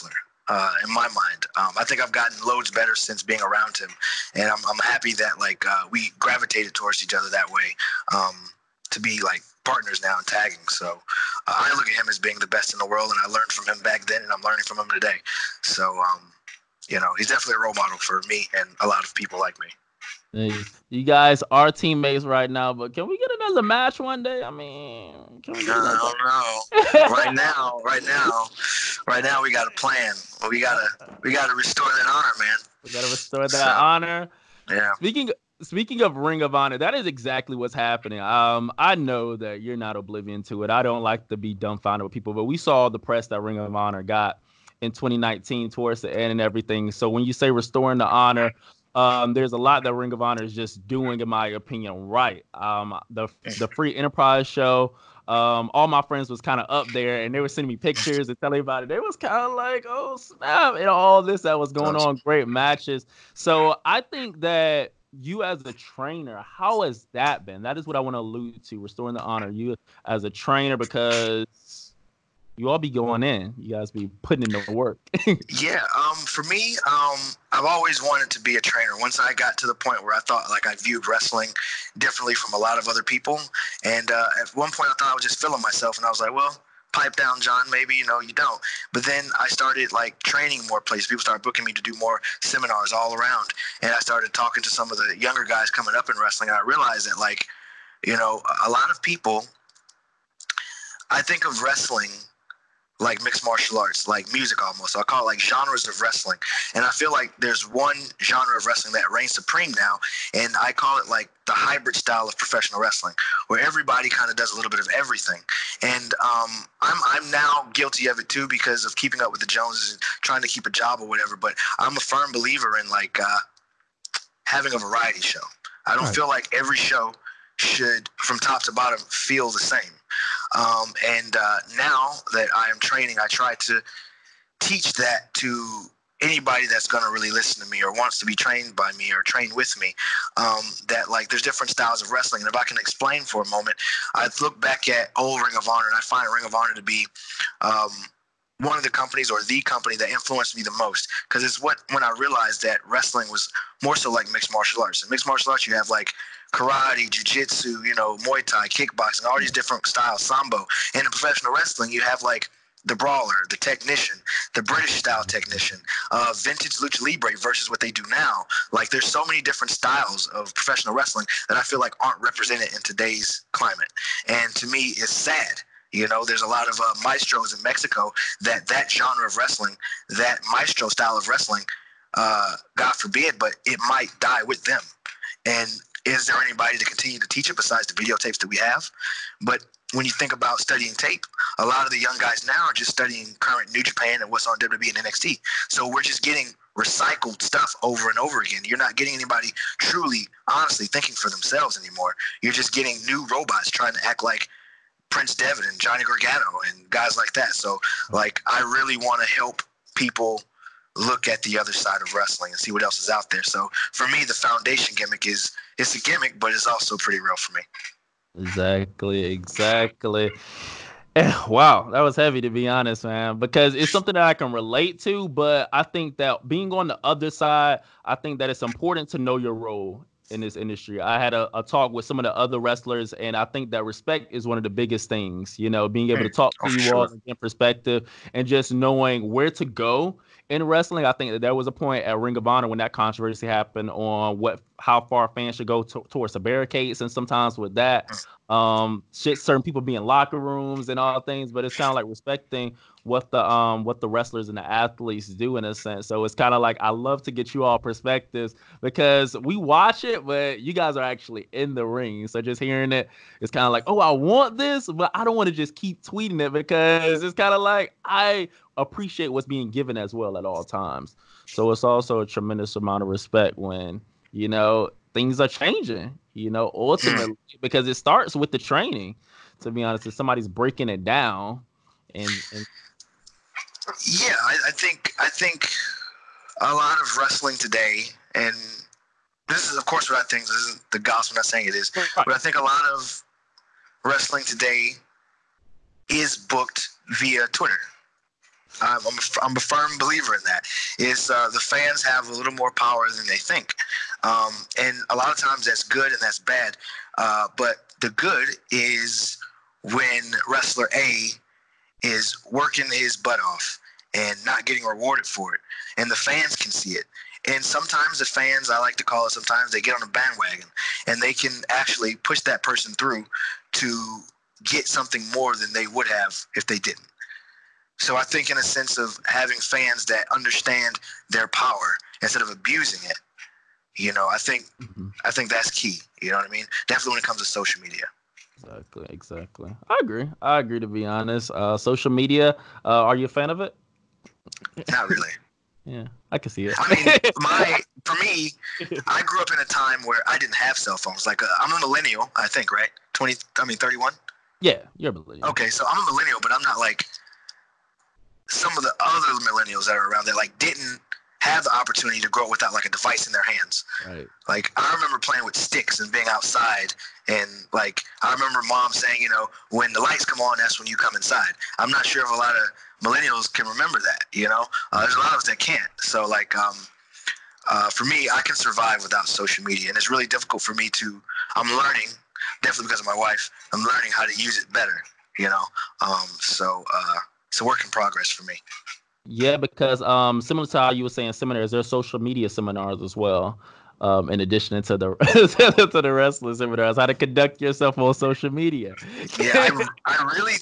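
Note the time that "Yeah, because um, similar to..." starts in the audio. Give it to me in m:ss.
6:29.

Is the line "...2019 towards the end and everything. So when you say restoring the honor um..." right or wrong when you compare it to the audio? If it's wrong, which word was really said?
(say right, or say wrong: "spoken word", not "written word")
right.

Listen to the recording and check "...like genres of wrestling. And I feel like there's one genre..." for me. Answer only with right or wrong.
right.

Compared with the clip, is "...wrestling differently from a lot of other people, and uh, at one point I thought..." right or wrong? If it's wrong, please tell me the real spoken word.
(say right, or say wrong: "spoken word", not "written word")
right.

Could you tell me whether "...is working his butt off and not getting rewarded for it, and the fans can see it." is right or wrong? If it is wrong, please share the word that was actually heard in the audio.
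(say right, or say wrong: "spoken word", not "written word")
right.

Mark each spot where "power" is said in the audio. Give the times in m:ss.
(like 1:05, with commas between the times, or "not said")
5:02, 5:31.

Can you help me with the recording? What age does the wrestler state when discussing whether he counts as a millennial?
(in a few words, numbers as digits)
31.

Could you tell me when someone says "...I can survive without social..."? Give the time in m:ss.
6:18.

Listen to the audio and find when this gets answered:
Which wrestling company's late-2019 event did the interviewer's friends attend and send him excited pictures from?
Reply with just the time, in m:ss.
0:53.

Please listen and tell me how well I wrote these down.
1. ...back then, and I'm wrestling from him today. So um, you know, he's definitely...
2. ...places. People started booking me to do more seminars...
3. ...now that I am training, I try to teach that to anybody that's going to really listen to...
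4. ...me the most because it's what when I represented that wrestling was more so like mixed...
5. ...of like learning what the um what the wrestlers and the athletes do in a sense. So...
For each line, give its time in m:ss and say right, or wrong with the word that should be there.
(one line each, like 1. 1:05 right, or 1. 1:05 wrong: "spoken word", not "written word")
1. 0:13 wrong: "learning", not "wrestling"
2. 1:30 right
3. 2:11 right
4. 2:30 wrong: "realized", not "represented"
5. 4:11 wrong: "respecting", not "learning".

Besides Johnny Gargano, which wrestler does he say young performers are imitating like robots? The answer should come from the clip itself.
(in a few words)
Prince Devitt.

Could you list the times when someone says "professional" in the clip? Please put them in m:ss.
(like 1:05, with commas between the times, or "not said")
1:52, 2:41, 2:50.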